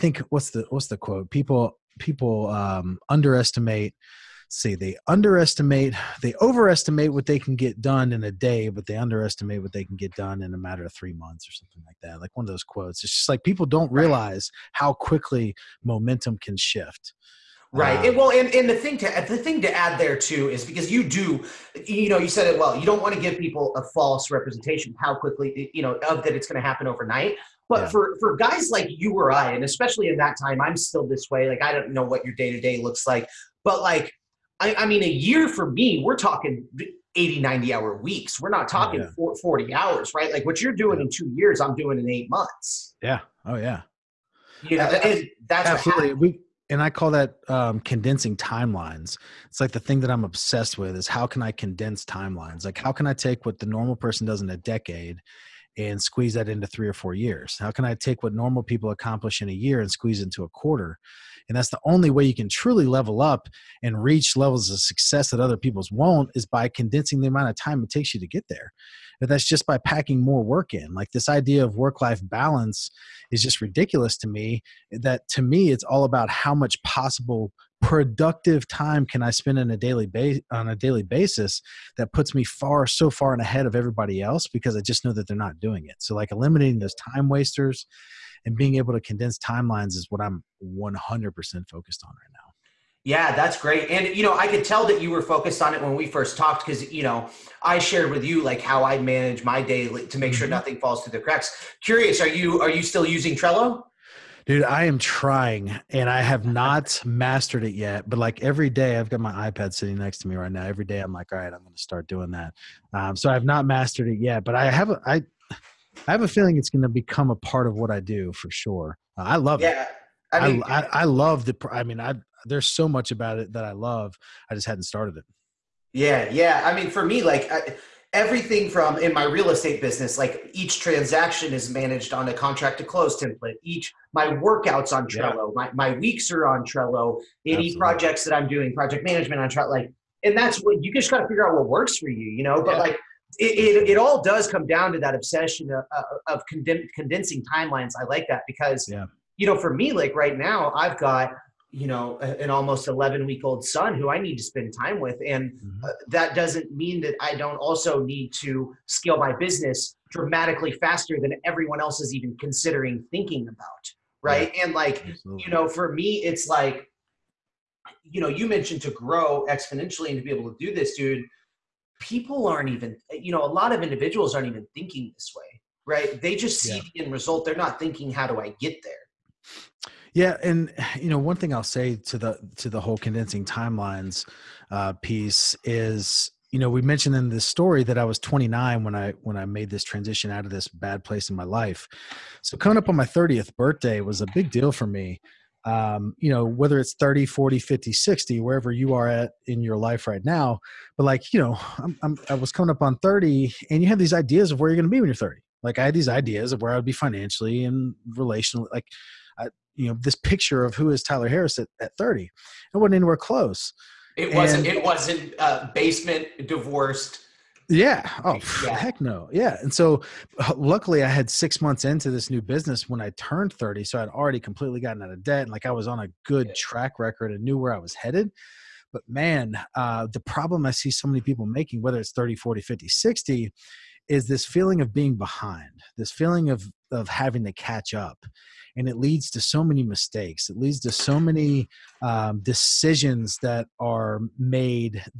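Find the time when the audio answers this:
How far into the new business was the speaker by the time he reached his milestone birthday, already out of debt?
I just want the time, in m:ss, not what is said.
3:41.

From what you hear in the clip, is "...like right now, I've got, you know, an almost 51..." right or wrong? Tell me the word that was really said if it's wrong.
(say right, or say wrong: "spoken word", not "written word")
wrong: "11", not "51".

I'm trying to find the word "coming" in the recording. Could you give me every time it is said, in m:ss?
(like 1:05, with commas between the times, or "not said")
3:12, 3:22.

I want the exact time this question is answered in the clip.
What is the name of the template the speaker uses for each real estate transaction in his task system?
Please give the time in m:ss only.
2:12.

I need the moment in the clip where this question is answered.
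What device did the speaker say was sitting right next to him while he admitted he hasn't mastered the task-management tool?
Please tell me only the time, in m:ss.
1:49.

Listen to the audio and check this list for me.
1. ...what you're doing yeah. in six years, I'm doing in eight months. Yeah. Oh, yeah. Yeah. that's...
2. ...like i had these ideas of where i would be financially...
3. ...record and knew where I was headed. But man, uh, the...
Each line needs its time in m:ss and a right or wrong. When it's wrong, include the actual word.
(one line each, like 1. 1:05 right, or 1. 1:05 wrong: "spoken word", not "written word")
1. 0:40 wrong: "two", not "six"
2. 3:25 right
3. 3:46 right.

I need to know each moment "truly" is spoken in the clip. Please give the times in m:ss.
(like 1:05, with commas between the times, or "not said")
1:02.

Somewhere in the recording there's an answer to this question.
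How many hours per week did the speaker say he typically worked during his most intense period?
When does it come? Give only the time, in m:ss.
0:37.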